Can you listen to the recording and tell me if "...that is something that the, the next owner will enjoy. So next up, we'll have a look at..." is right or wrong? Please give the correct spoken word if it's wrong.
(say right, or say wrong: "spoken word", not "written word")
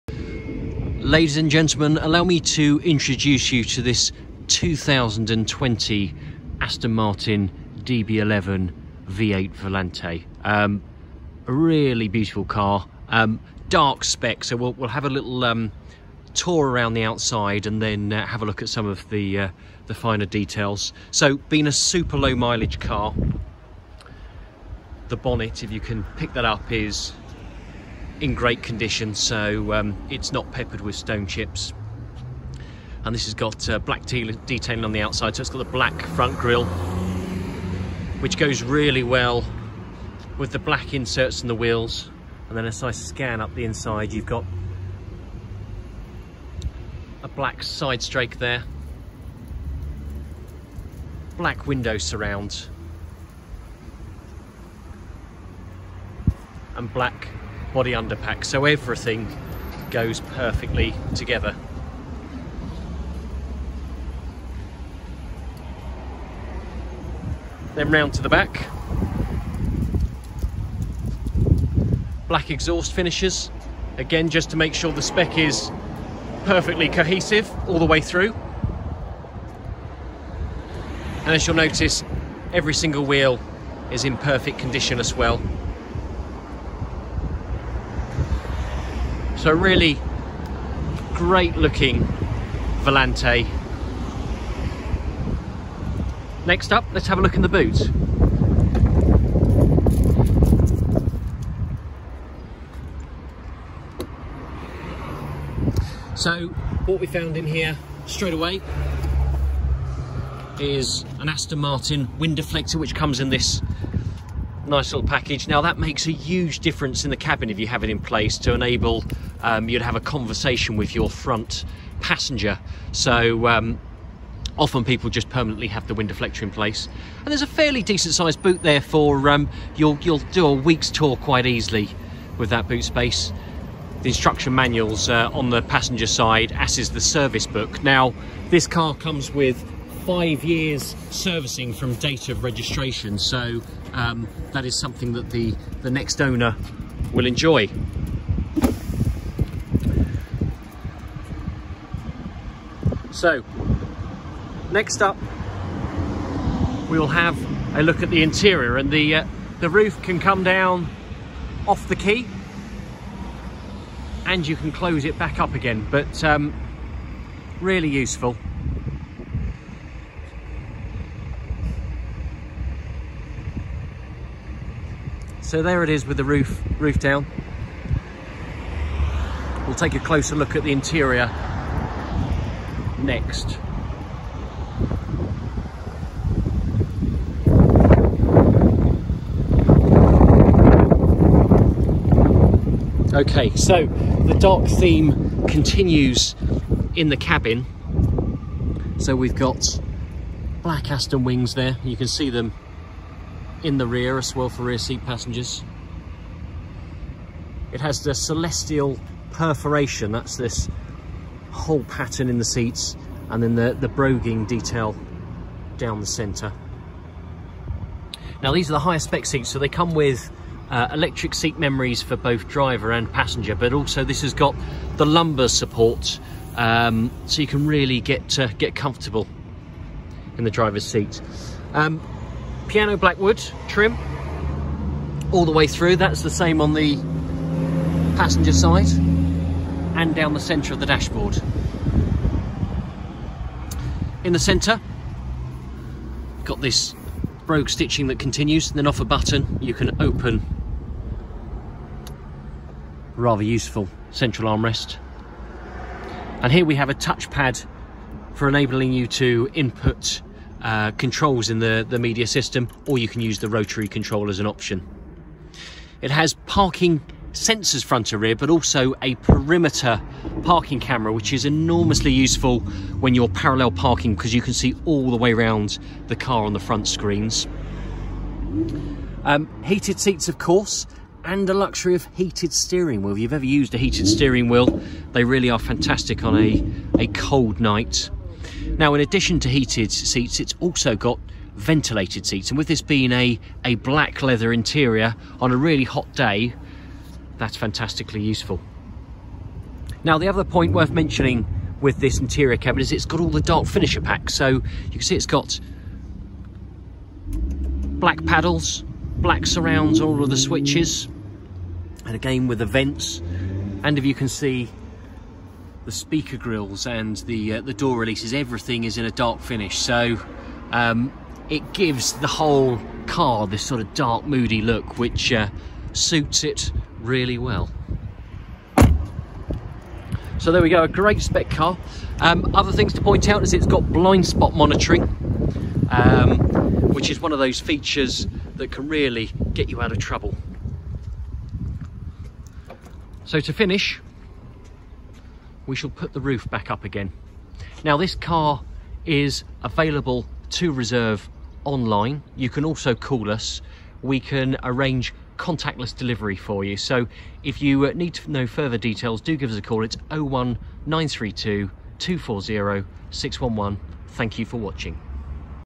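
right.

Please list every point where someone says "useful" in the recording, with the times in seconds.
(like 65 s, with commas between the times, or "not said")
167 s, 253 s, 272 s, 298 s.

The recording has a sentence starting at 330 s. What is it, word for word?
So there we go, a great spec car.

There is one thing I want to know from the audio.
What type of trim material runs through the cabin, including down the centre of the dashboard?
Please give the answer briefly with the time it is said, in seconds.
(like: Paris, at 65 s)
piano blackwood, at 232 s.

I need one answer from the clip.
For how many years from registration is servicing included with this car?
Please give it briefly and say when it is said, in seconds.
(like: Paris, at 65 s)
5, at 140 s.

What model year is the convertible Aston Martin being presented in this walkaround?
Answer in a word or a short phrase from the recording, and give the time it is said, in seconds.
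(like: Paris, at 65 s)
2020, at 4 s.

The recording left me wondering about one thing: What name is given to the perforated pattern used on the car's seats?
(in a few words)
celestial perforation.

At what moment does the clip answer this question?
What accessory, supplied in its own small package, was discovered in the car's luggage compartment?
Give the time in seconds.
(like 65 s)
111 s.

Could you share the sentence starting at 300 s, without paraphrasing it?
Now the other point worth mentioning with this interior cabin is it's got all the dark finisher packs.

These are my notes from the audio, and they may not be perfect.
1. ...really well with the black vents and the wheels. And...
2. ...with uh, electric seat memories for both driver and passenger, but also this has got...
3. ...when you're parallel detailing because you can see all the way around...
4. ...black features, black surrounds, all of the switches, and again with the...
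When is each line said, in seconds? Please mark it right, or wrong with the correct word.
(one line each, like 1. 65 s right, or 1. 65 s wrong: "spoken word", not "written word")
1. 38 s wrong: "inserts", not "vents"
2. 219 s right
3. 272 s wrong: "parking", not "detailing"
4. 307 s wrong: "paddles", not "features".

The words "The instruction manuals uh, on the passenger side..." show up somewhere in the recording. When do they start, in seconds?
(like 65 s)
134 s.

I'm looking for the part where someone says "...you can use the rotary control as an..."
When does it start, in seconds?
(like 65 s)
262 s.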